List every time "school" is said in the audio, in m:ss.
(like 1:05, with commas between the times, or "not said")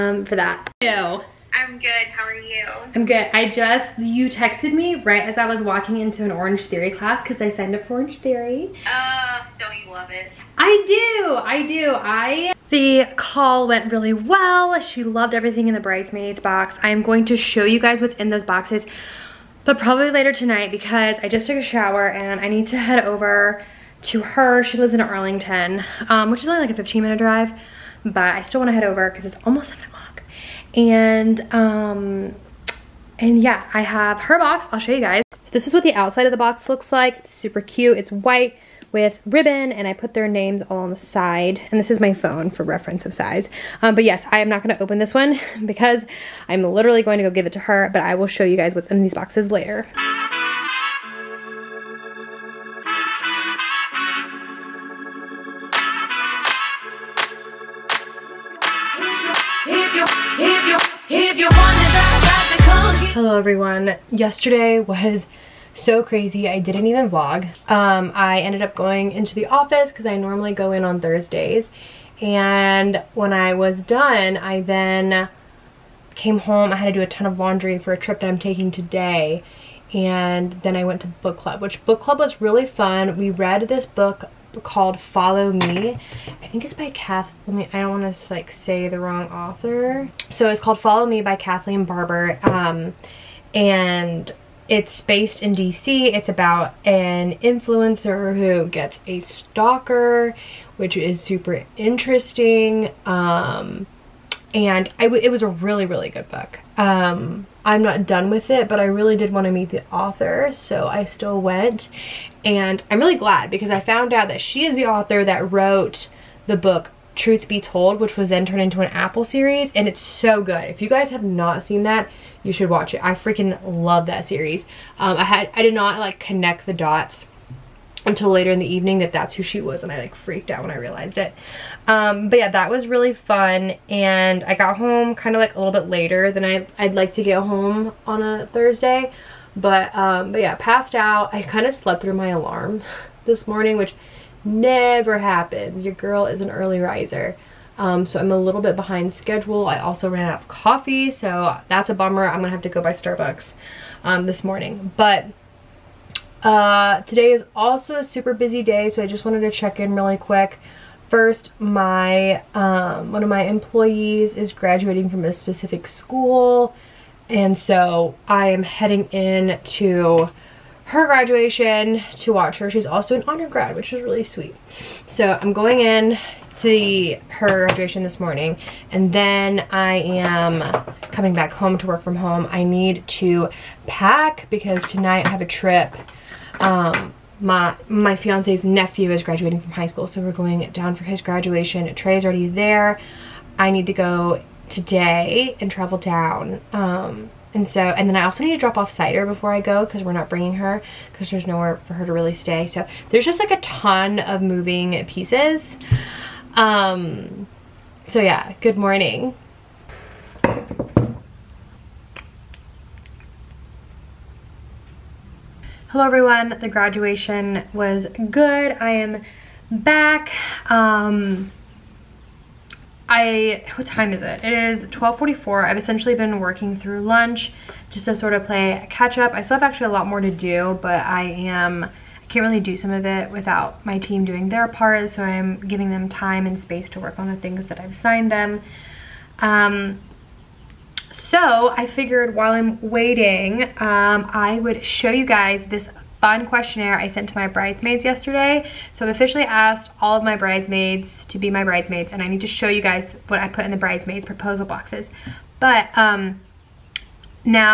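2:45, 3:09.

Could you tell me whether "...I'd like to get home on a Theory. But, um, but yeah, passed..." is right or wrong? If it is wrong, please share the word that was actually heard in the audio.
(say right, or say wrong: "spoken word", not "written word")
wrong: "Thursday", not "Theory".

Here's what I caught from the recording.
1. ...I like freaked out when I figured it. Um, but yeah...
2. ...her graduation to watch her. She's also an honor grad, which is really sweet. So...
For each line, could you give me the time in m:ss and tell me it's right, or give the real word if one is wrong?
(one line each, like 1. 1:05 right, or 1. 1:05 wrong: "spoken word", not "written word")
1. 2:09 wrong: "realized", not "figured"
2. 2:50 right.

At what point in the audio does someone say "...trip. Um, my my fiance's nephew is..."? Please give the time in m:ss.
3:05.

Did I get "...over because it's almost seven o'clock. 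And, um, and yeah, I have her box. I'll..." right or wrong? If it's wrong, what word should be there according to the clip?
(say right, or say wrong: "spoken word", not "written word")
right.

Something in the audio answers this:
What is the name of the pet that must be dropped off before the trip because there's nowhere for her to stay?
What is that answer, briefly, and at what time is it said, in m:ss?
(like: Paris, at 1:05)
Cider, at 3:18.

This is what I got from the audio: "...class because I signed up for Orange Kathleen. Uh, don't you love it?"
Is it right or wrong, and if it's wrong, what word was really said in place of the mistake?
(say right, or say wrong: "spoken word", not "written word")
wrong: "Theory", not "Kathleen".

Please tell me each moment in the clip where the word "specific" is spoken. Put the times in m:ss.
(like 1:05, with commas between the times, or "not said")
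2:45.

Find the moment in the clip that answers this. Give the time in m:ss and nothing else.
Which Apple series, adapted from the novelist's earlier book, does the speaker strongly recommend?
1:57.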